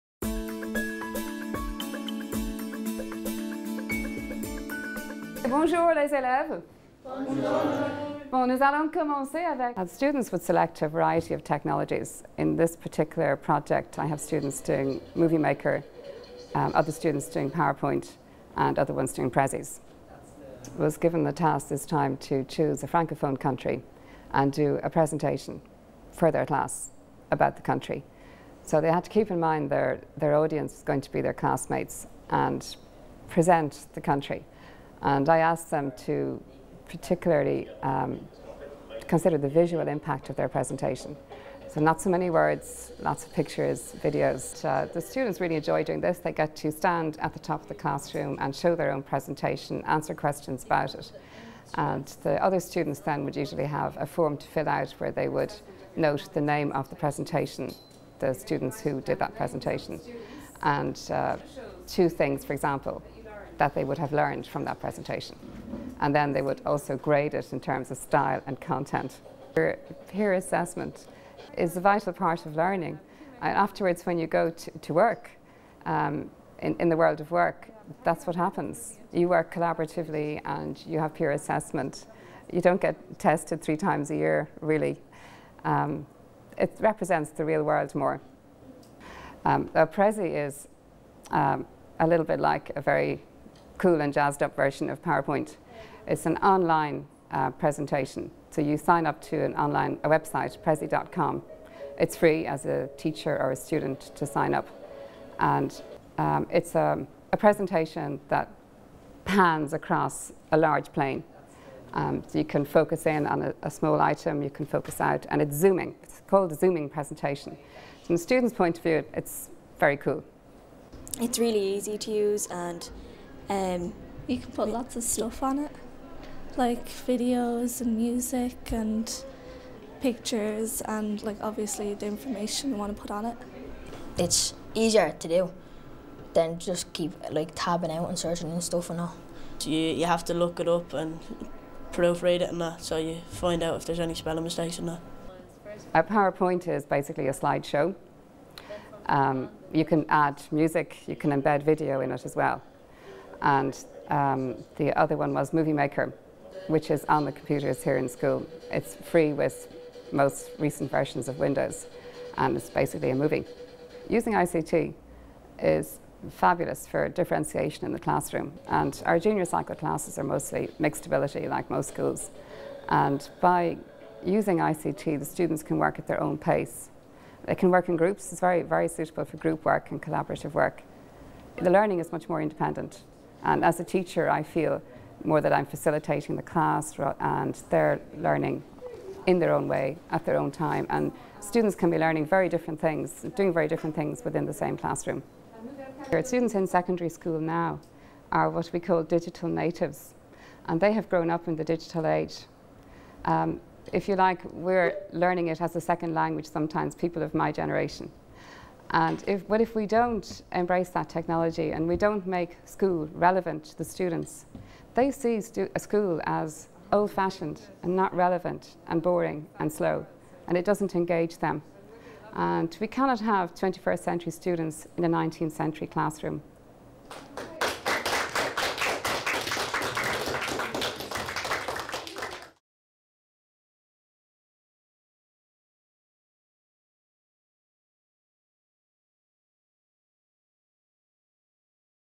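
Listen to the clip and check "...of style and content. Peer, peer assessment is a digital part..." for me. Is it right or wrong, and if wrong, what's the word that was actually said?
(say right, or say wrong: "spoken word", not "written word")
wrong: "vital", not "digital".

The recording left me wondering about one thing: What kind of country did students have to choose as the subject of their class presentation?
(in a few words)
Francophone country.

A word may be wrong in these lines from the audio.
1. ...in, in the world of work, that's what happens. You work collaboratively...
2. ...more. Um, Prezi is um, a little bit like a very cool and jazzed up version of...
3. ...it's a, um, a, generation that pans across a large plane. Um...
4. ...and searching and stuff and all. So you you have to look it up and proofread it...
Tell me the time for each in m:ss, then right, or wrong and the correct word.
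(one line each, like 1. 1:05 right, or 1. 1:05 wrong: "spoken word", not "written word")
1. 1:16 right
2. 1:27 right
3. 1:46 wrong: "presentation", not "generation"
4. 2:18 right.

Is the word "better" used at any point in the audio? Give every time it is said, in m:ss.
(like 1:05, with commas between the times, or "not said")
not said.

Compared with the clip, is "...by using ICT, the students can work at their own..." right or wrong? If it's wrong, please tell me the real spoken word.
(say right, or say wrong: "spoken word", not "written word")
right.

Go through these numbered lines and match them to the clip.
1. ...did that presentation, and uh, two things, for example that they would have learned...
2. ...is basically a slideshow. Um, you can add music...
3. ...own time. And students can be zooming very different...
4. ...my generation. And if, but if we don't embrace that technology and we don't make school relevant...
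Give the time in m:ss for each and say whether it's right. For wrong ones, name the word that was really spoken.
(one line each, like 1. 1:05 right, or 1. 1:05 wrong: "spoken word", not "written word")
1. 0:59 right
2. 2:26 right
3. 3:10 wrong: "learning", not "zooming"
4. 3:27 right.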